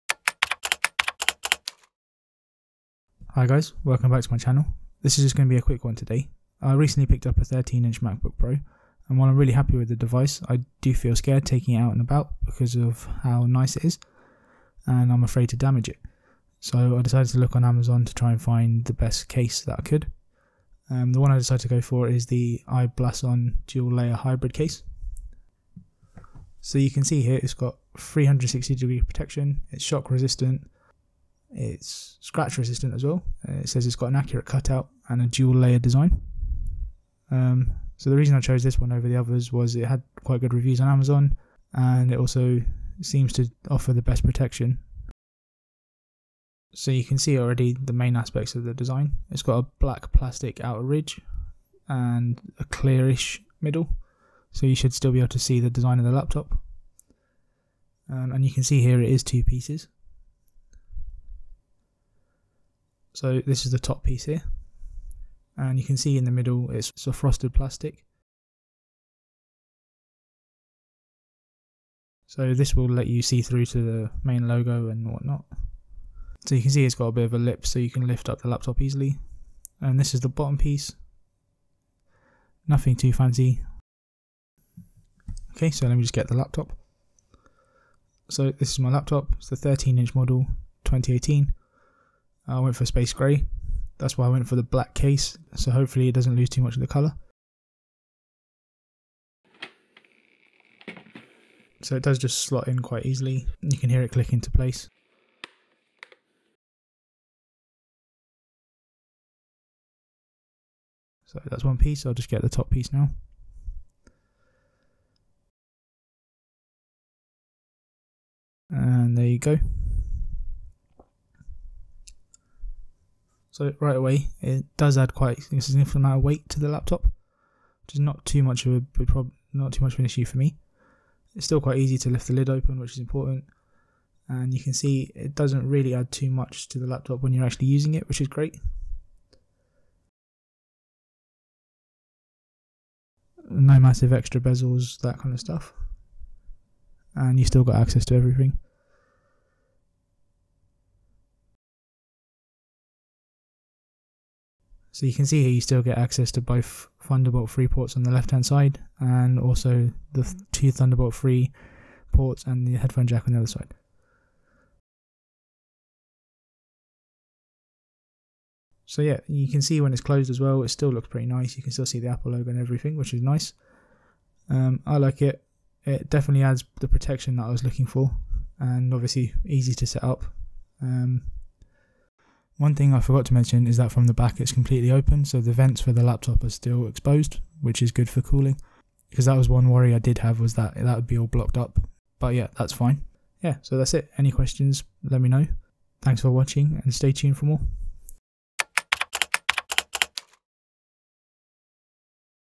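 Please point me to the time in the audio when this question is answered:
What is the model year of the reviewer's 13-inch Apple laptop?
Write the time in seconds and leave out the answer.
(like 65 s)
90 s.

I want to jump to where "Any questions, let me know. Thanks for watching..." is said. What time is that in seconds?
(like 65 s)
194 s.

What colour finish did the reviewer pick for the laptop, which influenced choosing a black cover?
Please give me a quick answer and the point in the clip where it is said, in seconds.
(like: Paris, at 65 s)
Space grey, at 92 s.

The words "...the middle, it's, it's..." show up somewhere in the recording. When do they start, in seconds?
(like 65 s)
66 s.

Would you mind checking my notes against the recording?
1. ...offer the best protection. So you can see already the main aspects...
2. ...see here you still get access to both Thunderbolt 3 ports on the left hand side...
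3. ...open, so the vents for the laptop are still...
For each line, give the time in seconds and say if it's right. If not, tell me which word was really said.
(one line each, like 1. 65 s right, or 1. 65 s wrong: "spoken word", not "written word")
1. 43 s right
2. 155 s right
3. 184 s right.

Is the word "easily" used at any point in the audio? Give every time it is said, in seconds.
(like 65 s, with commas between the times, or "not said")
78 s, 103 s.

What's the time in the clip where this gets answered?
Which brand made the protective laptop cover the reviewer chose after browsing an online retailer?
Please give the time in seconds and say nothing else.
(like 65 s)
22 s.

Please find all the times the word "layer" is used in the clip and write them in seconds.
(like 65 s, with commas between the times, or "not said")
23 s, 35 s.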